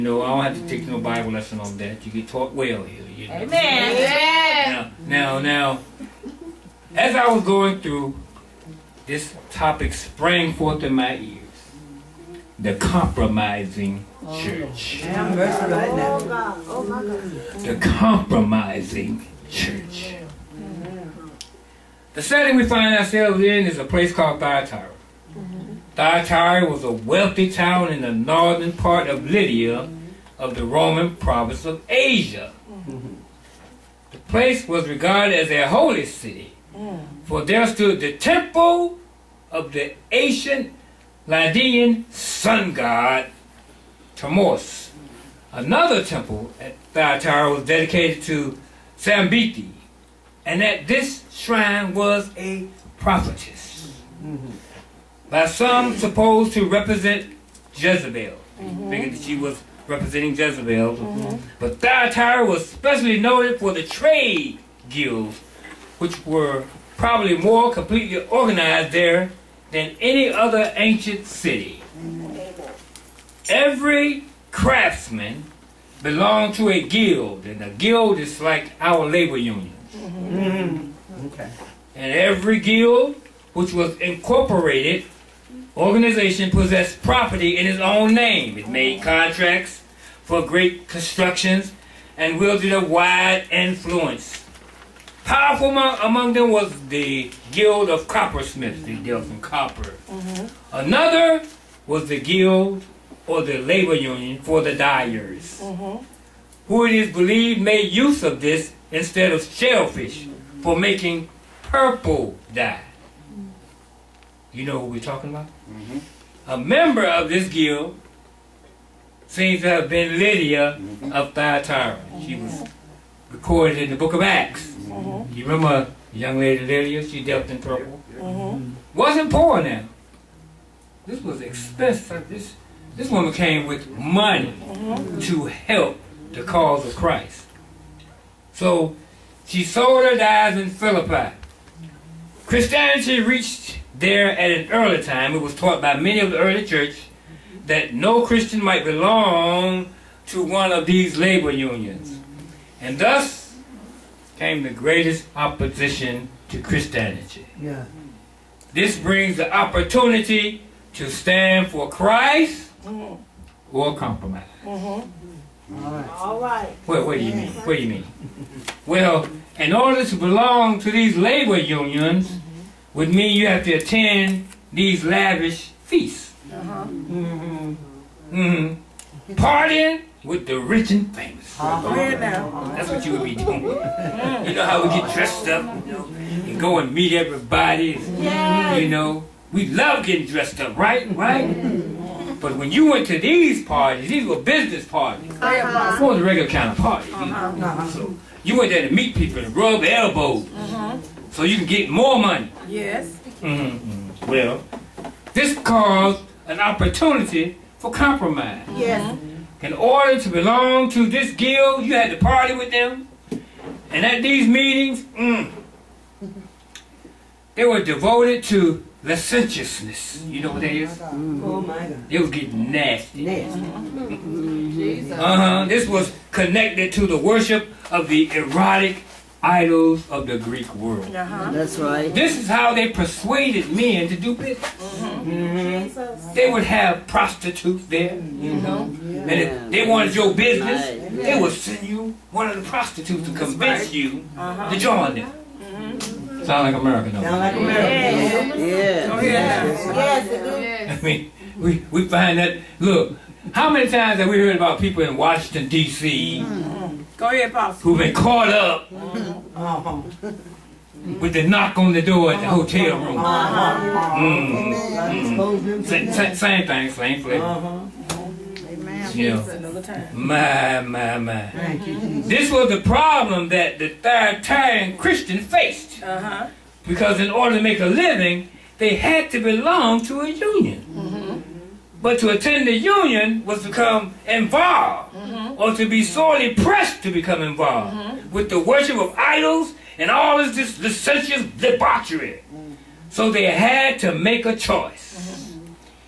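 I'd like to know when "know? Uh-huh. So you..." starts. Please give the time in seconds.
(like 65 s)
197 s.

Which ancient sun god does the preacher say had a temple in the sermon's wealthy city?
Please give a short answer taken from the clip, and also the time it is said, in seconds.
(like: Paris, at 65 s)
Tammuz, at 44 s.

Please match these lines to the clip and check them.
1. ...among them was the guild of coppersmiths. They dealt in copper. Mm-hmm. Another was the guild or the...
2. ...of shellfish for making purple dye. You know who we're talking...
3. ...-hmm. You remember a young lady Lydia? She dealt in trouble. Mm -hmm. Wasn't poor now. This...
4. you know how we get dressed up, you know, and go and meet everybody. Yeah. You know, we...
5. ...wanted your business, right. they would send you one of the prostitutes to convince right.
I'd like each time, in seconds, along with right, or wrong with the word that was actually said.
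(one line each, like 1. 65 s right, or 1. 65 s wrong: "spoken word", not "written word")
1. 95 s right
2. 109 s right
3. 124 s right
4. 183 s right
5. 239 s right.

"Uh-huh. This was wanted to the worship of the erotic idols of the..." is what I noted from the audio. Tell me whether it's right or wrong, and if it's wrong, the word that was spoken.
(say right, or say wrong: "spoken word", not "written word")
wrong: "connected", not "wanted".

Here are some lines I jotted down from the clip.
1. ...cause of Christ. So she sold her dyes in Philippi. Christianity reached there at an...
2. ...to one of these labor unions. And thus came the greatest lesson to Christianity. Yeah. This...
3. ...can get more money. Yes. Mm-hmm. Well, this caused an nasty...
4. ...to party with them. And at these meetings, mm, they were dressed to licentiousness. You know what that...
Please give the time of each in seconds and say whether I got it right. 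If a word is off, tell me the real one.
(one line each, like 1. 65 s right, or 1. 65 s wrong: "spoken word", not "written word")
1. 136 s right
2. 150 s wrong: "opposition", not "lesson"
3. 201 s wrong: "opportunity", not "nasty"
4. 212 s wrong: "devoted", not "dressed".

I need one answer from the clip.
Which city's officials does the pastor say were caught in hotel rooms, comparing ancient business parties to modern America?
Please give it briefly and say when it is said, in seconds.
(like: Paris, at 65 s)
Washington, D.C., at 255 s.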